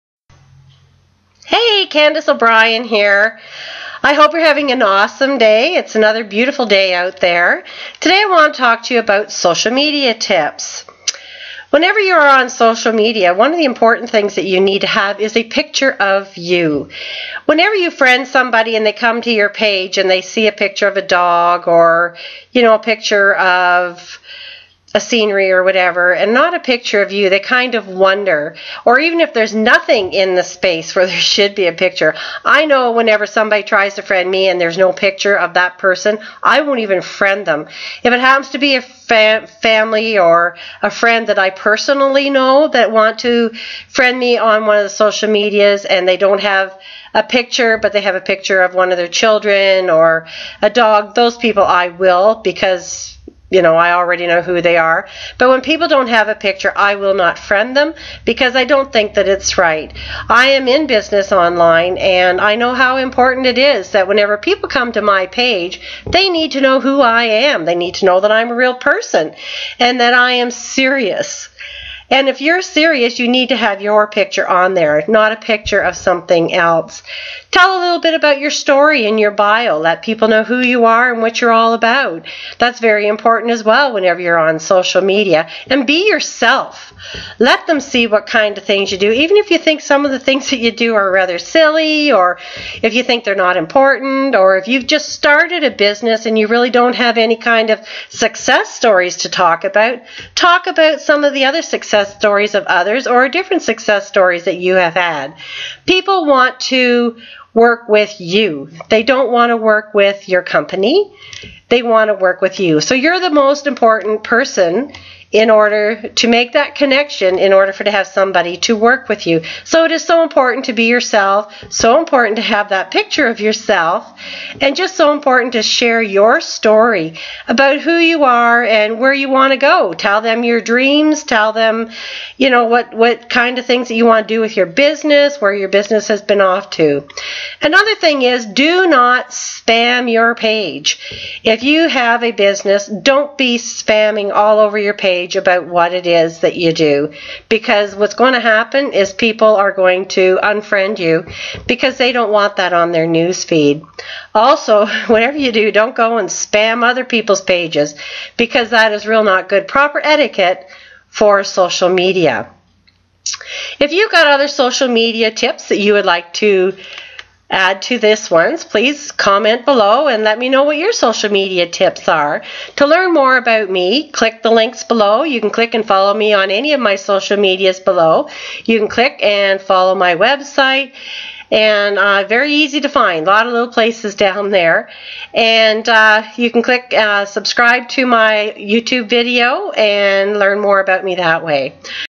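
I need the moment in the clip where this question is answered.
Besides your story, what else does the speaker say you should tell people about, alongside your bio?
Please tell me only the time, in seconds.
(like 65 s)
130 s.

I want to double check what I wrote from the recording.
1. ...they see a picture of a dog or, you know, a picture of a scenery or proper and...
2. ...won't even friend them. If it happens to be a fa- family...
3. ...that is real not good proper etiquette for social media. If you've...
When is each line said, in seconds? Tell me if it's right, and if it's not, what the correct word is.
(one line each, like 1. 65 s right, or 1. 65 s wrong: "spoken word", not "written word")
1. 20 s wrong: "whatever", not "proper"
2. 36 s right
3. 158 s right.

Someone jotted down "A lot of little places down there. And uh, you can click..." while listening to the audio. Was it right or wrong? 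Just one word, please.
right.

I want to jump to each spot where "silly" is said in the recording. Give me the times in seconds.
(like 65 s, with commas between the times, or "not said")
91 s.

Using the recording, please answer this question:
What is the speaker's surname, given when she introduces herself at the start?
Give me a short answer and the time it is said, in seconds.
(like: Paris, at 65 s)
O'Brien, at 2 s.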